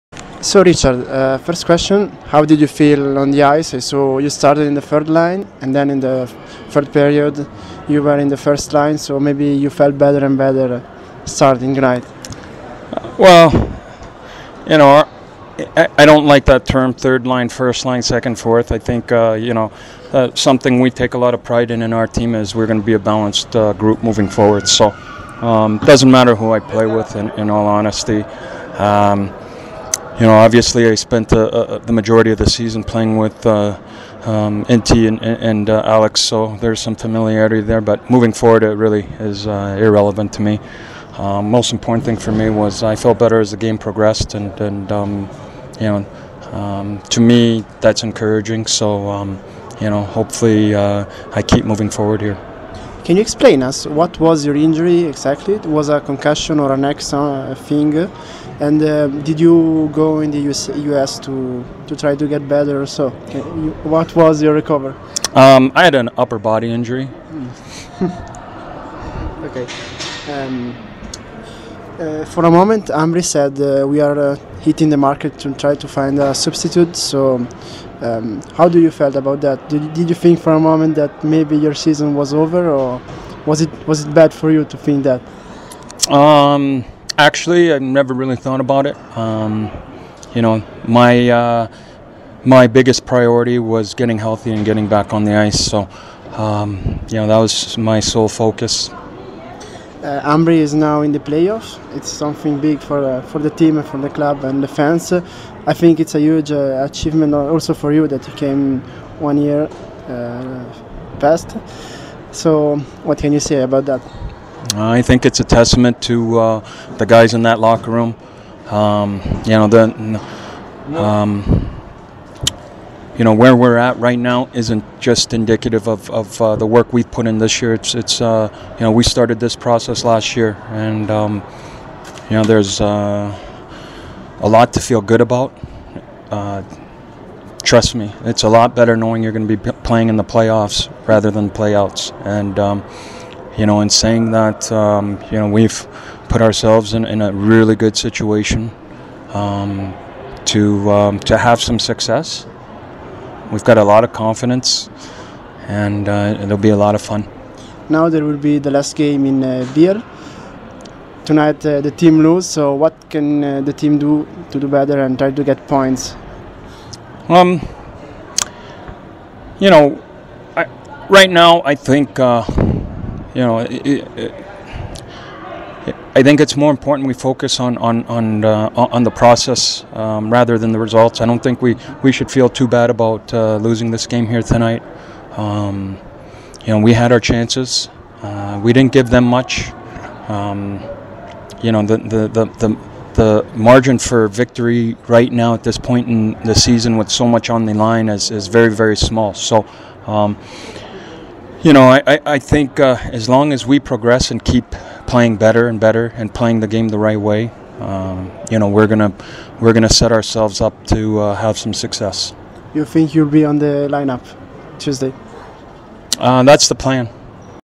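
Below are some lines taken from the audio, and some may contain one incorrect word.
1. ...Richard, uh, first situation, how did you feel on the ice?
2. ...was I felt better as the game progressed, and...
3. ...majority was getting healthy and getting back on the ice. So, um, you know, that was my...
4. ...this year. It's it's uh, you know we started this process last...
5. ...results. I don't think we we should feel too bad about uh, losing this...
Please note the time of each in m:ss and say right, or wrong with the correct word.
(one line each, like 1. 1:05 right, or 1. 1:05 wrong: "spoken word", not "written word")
1. 0:00 wrong: "question", not "situation"
2. 0:42 right
3. 1:33 wrong: "priority", not "majority"
4. 2:07 right
5. 3:00 right.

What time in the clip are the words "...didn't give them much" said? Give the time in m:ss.
3:08.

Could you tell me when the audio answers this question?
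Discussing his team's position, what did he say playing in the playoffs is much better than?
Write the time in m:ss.
2:21.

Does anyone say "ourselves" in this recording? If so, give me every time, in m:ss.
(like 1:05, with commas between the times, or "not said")
2:26, 3:30.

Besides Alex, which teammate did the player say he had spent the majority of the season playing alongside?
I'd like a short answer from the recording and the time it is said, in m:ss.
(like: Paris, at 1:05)
Inti, at 0:34.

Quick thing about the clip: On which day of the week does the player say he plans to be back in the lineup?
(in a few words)
Tuesday.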